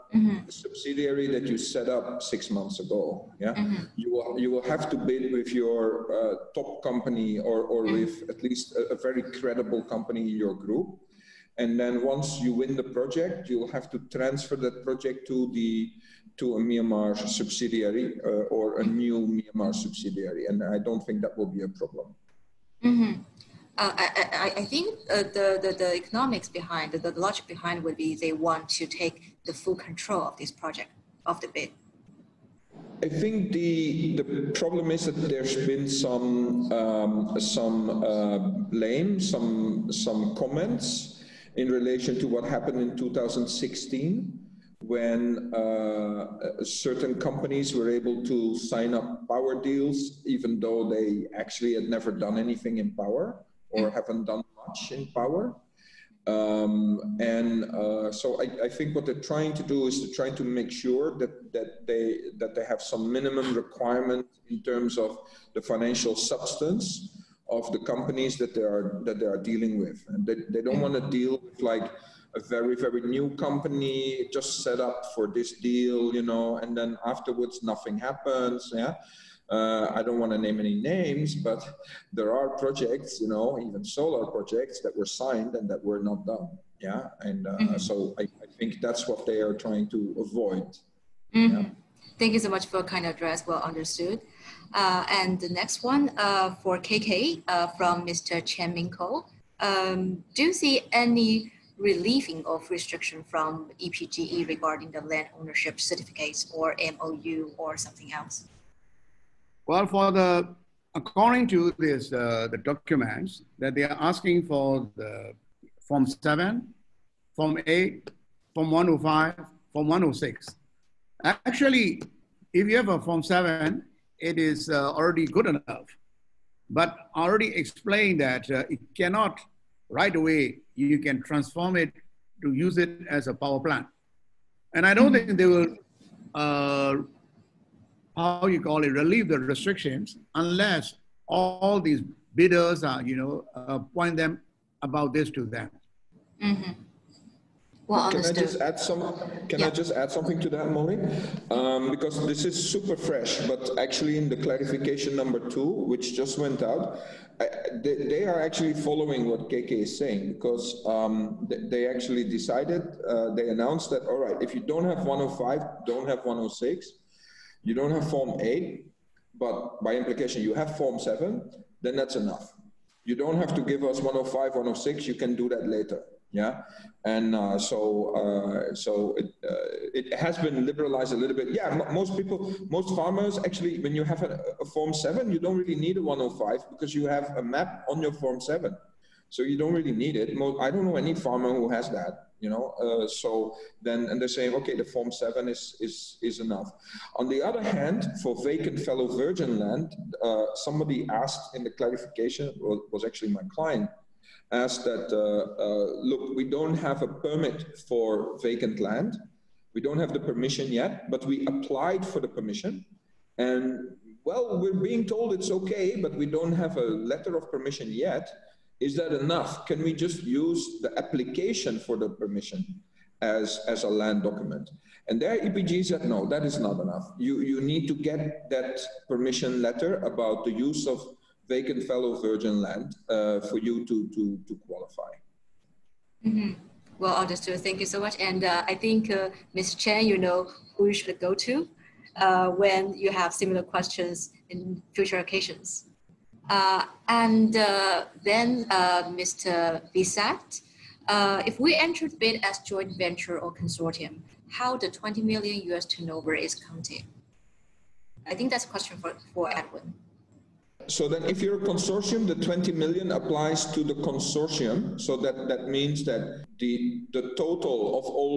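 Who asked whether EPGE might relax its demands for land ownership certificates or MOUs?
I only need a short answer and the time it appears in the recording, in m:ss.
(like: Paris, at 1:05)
Chen Ming, at 1:38.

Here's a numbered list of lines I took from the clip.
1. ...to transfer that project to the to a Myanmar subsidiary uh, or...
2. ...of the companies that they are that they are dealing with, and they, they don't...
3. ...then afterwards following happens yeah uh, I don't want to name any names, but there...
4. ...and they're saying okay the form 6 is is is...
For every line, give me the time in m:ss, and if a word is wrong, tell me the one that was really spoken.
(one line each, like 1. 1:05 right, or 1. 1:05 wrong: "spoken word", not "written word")
1. 0:13 right
2. 1:07 right
3. 1:16 wrong: "nothing", not "following"
4. 3:14 wrong: "7", not "6".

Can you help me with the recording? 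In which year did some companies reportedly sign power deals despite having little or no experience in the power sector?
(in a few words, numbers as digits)
2016.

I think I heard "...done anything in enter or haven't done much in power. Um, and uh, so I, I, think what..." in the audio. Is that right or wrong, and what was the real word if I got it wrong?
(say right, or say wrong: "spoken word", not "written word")
wrong: "power", not "enter".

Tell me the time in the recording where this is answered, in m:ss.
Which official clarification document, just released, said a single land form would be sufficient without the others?
2:34.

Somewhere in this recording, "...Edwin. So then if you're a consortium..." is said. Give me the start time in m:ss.
4:19.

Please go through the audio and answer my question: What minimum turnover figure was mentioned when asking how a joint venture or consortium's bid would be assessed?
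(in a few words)
$20 million.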